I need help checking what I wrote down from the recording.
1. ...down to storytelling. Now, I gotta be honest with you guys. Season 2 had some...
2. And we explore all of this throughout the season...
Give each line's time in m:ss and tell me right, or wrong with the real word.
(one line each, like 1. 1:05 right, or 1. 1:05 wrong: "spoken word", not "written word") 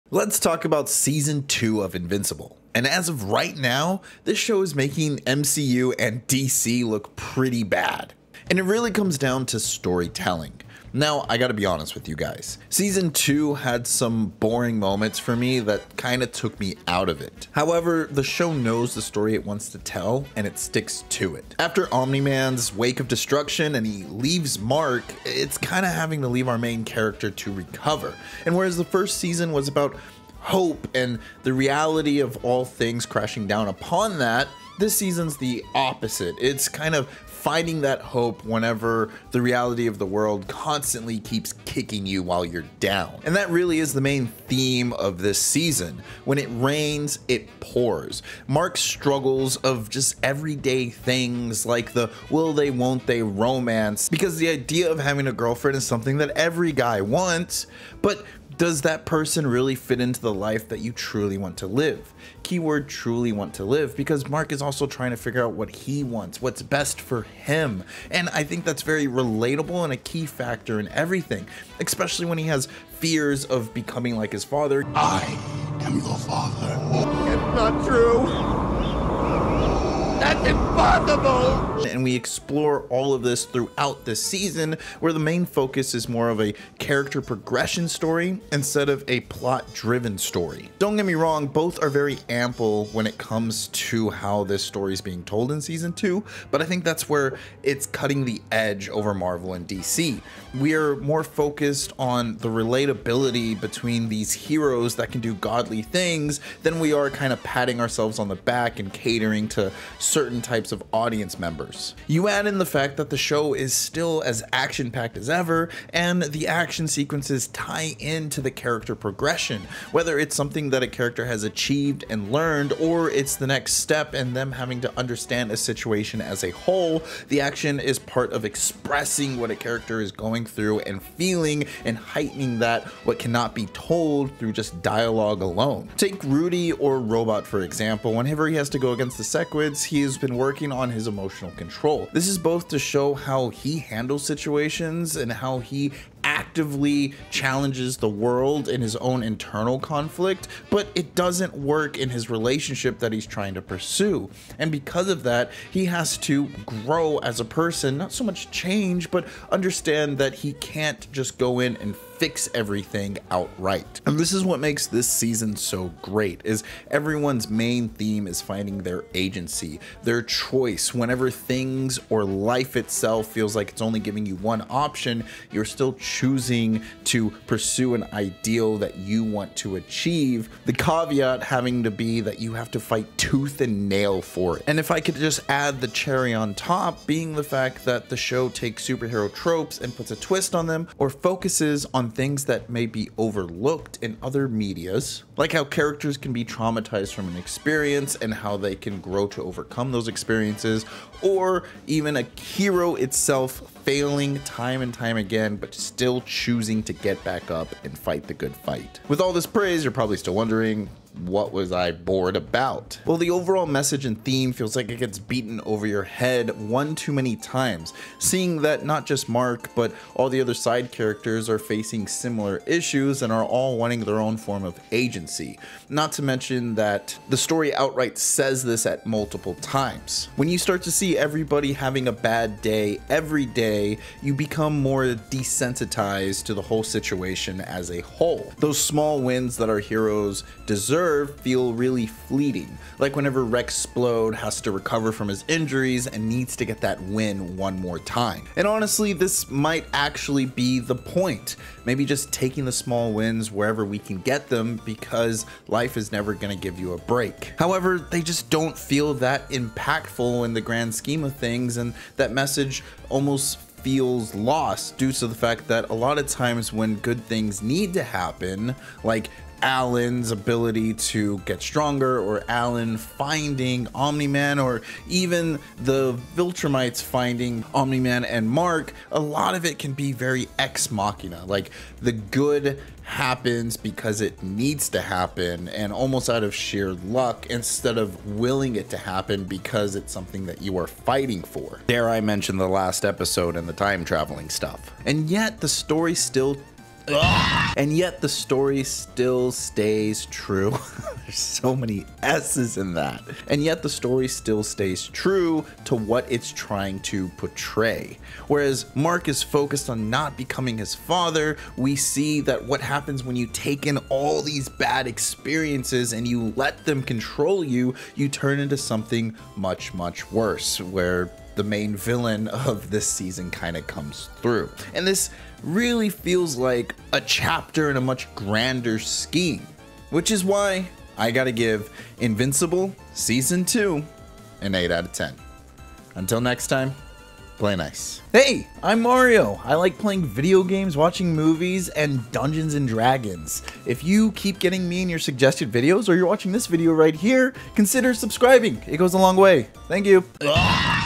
1. 0:09 right
2. 1:20 right.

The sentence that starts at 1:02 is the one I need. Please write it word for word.
Keyword truly want to live because Mark is also trying to figure out what he wants, what's best for him.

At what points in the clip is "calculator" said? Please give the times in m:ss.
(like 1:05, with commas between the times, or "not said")
not said.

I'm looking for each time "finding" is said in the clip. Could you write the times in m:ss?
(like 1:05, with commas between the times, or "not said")
0:37, 2:48, 4:32, 4:37.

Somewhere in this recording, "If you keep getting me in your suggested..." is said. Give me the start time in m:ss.
5:43.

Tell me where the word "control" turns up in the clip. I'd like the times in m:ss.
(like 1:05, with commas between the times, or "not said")
2:21, 5:17.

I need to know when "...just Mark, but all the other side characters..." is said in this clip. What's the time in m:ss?
3:39.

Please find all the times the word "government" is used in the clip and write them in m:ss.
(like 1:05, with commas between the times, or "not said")
not said.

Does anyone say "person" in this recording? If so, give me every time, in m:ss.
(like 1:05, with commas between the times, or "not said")
0:59, 2:37.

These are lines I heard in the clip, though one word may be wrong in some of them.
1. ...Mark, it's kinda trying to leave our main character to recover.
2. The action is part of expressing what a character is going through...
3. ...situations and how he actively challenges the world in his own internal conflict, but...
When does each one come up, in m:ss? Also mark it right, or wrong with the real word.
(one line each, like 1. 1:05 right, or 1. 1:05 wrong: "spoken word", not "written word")
1. 0:24 wrong: "having", not "trying"
2. 2:07 right
3. 2:24 right.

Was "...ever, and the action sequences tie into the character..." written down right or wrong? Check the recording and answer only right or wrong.
right.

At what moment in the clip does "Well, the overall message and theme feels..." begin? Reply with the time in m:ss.
3:33.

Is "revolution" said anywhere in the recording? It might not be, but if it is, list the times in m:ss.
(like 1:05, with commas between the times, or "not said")
not said.